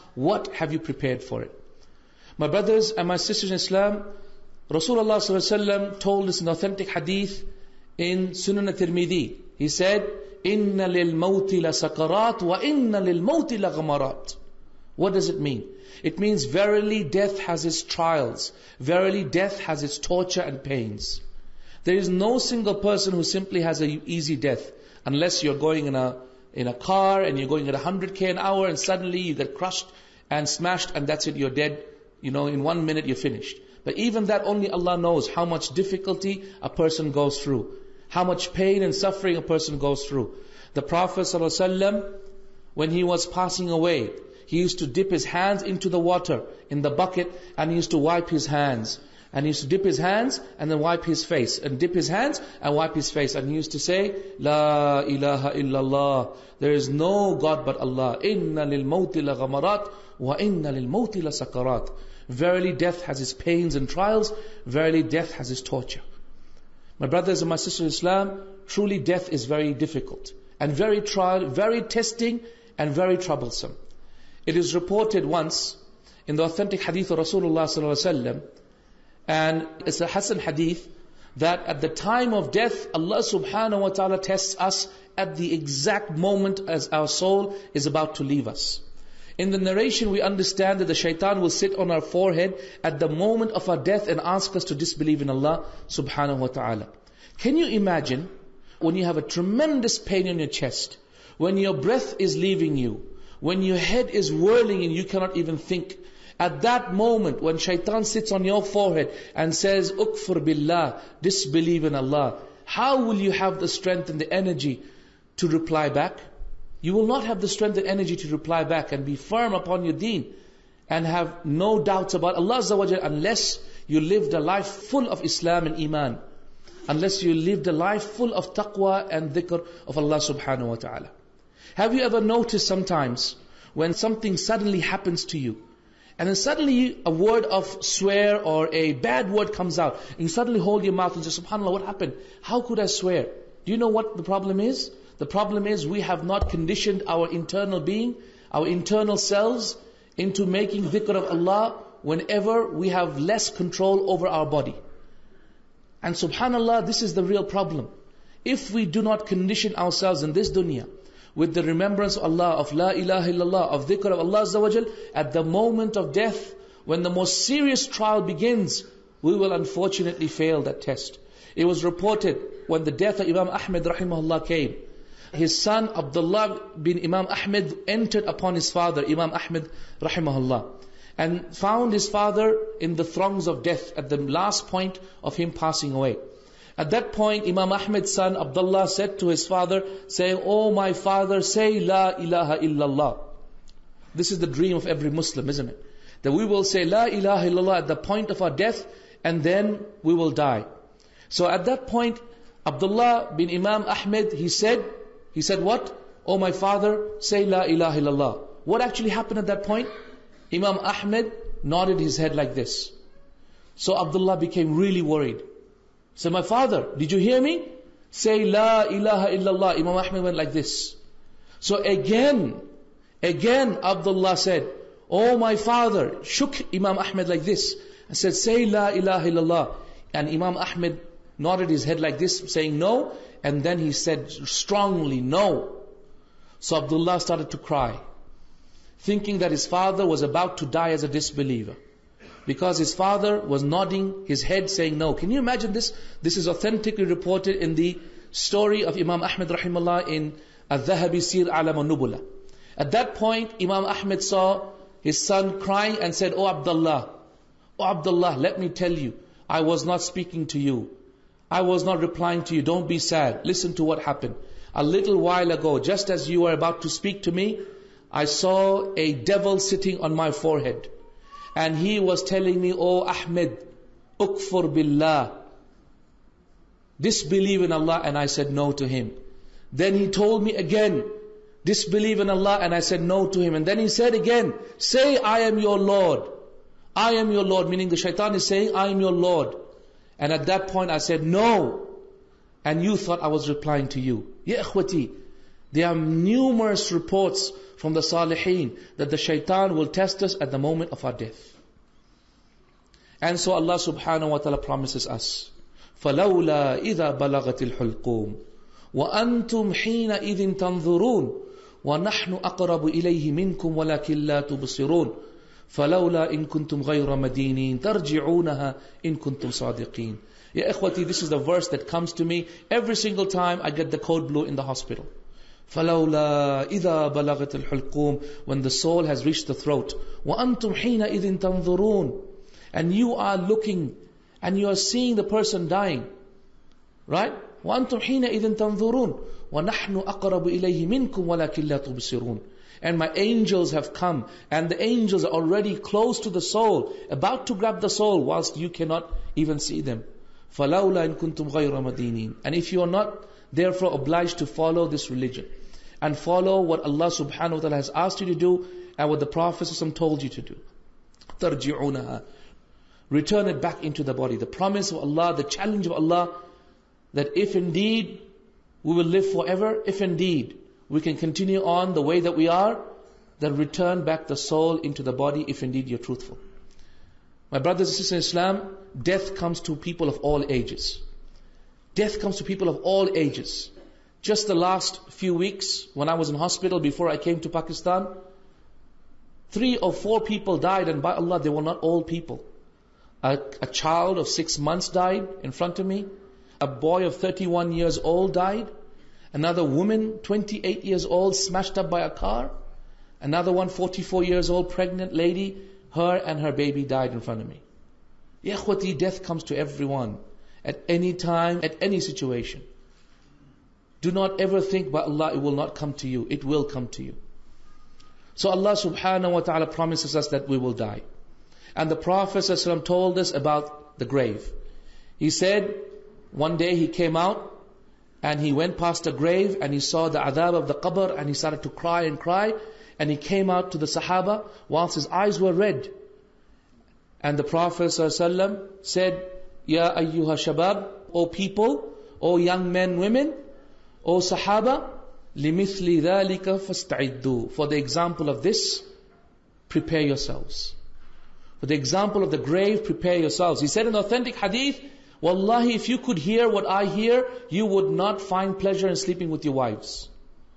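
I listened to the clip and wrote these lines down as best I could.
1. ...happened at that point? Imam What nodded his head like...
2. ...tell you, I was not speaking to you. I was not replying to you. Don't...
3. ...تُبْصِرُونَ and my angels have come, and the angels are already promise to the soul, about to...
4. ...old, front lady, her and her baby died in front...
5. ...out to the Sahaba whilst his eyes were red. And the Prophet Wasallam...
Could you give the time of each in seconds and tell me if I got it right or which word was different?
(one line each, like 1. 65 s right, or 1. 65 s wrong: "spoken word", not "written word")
1. 209 s wrong: "Ahmed", not "What"
2. 258 s right
3. 341 s wrong: "close", not "promise"
4. 404 s wrong: "pregnant", not "front"
5. 433 s right.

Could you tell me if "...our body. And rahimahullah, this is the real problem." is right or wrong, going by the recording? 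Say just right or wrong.
wrong.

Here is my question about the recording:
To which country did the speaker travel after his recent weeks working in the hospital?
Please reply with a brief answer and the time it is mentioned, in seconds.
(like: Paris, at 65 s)
Pakistan, at 387 s.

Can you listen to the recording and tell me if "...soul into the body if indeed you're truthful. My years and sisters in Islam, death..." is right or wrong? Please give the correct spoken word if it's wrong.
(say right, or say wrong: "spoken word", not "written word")
wrong: "brothers", not "years".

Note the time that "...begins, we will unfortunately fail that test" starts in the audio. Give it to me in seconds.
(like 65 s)
168 s.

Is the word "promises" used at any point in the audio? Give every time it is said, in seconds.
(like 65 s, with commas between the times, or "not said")
304 s, 364 s, 419 s.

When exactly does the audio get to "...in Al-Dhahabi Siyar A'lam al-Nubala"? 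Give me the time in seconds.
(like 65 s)
250 s.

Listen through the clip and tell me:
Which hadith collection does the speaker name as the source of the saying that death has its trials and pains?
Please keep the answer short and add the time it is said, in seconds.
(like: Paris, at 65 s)
Sunan al-Tirmidhi, at 8 s.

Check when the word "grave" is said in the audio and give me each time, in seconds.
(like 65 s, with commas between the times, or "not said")
424 s, 429 s, 452 s.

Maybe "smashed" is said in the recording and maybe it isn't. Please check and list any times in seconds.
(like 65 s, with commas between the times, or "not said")
30 s, 401 s.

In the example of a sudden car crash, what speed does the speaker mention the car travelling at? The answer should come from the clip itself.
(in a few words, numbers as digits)
100k an hour.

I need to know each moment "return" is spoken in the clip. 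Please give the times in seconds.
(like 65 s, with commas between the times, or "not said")
363 s, 373 s.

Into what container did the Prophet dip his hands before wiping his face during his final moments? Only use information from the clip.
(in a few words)
bucket.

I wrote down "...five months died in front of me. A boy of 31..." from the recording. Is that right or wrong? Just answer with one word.
wrong.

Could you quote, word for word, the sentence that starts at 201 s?
So at that point, Abdullah bin Imam Ahmed, he said, he said what?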